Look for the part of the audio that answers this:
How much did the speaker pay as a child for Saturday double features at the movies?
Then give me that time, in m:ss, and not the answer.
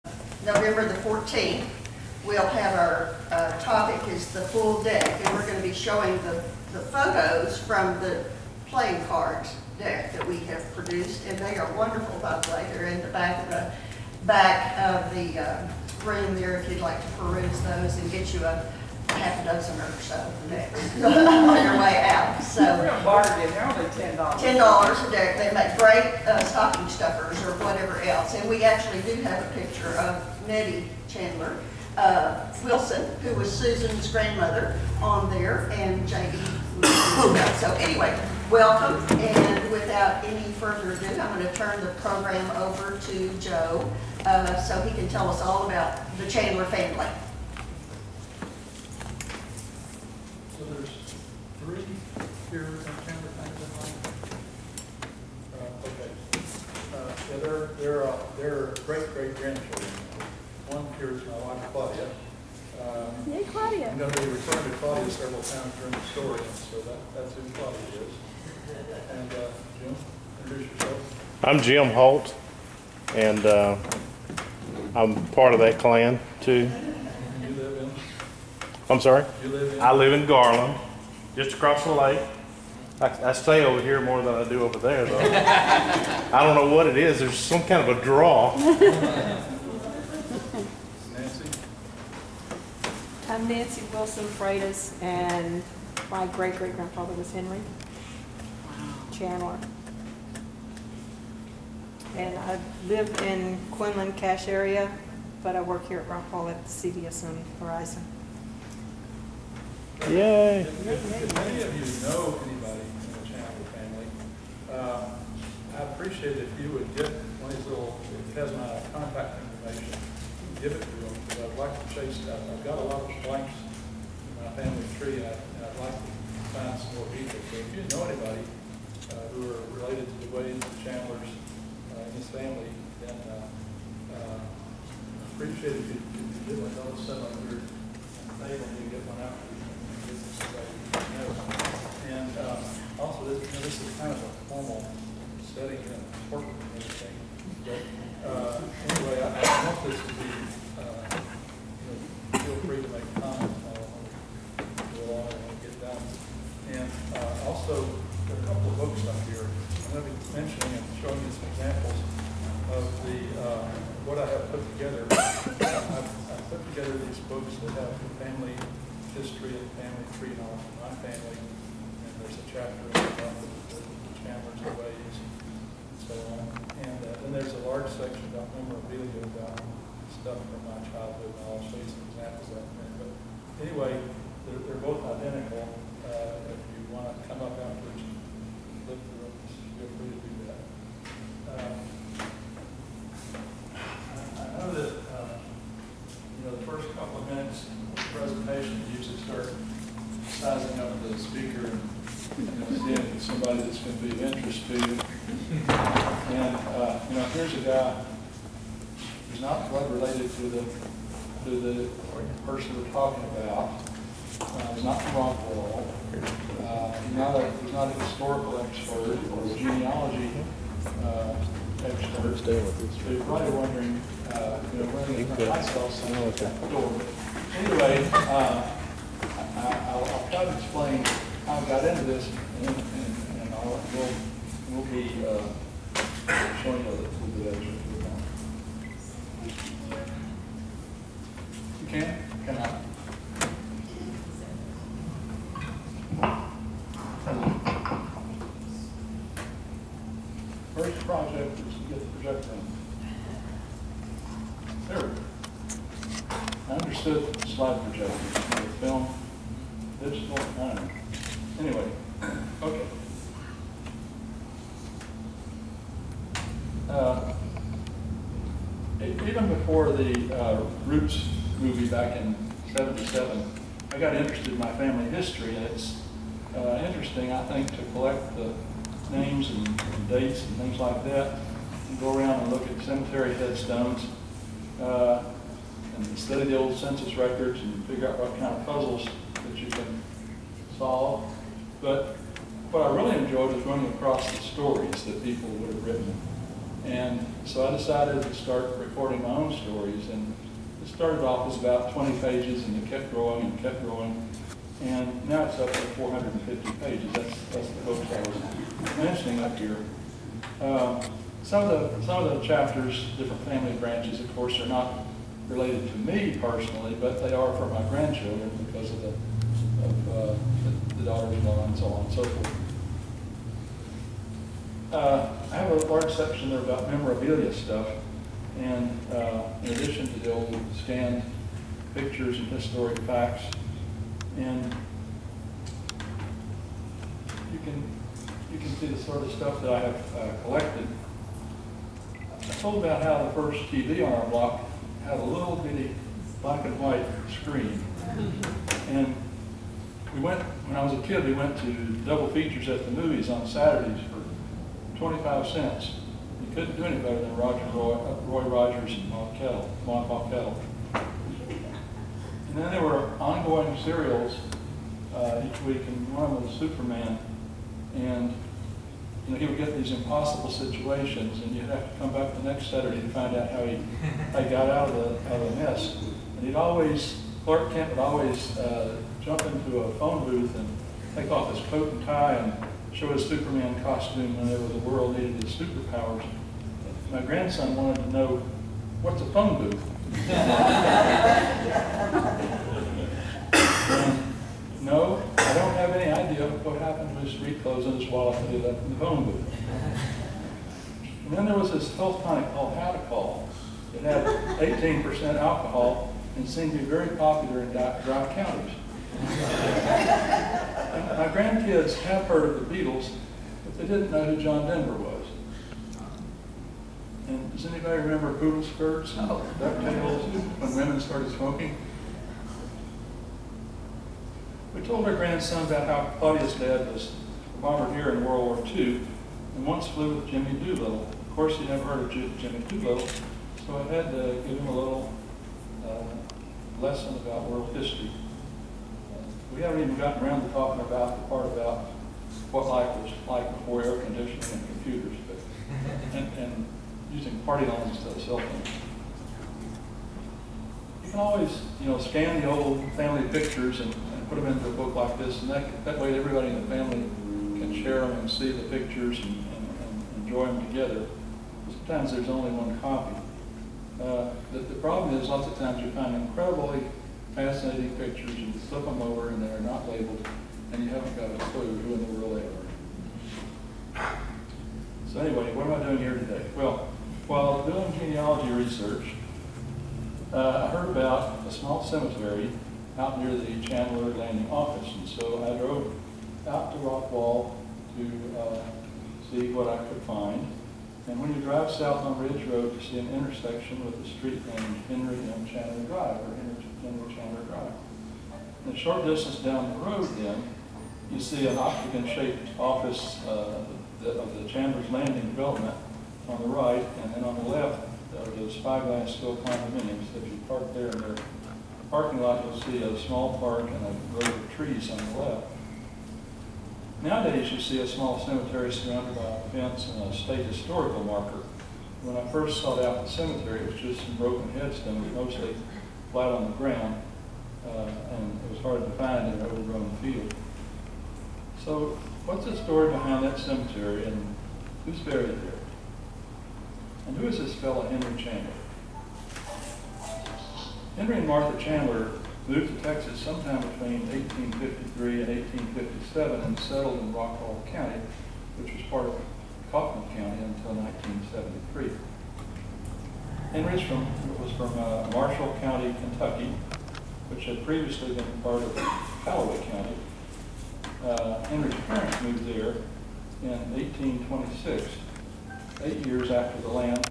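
5:54.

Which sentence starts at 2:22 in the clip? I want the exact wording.
And um, also, this, you know, this is kind of a formal setting and important thing.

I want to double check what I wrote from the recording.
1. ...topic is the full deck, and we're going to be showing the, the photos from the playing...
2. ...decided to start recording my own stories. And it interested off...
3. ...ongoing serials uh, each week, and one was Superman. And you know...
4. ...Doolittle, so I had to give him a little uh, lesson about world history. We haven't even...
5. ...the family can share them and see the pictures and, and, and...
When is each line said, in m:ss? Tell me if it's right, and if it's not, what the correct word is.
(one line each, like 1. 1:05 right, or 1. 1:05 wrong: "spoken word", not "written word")
1. 0:03 right
2. 4:57 wrong: "started", not "interested"
3. 6:03 right
4. 7:12 right
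5. 7:36 right.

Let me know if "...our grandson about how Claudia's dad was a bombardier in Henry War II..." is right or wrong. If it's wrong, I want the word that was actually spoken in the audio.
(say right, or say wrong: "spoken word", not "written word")
wrong: "World", not "Henry".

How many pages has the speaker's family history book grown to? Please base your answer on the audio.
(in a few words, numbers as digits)
450.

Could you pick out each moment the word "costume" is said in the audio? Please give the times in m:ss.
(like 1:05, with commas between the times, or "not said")
6:23.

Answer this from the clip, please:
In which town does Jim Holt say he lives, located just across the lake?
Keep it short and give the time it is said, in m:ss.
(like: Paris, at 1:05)
Garland, at 1:20.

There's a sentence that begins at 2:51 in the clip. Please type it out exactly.
And there's a chapter about the, the, the Chandler's ways and so on.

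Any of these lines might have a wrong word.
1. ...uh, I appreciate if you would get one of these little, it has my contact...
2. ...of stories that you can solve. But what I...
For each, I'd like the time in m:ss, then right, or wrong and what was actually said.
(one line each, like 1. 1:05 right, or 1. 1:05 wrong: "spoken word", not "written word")
1. 1:54 right
2. 4:48 wrong: "puzzles", not "stories".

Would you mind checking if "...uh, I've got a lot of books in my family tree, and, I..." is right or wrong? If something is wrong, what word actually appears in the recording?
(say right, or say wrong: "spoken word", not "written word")
wrong: "blanks", not "books".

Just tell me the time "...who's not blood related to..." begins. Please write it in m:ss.
3:29.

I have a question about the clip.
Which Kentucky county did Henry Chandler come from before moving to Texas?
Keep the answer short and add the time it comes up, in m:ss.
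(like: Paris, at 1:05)
Marshall County, at 9:15.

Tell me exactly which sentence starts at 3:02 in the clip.
But anyway, they're, they're both identical.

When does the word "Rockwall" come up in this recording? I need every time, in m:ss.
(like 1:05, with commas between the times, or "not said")
1:46, 3:35, 8:06, 9:07.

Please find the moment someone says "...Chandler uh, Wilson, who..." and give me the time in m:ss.
0:31.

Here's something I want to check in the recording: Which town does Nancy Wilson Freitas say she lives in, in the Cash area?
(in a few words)
Quinlan.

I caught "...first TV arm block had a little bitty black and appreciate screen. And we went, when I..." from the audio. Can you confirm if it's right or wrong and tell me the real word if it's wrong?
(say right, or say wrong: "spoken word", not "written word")
wrong: "white", not "appreciate".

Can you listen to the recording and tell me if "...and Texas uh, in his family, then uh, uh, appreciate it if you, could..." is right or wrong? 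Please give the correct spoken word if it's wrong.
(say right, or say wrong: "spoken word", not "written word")
wrong: "Chandlers", not "Texas".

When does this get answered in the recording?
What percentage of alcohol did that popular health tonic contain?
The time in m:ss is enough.
6:44.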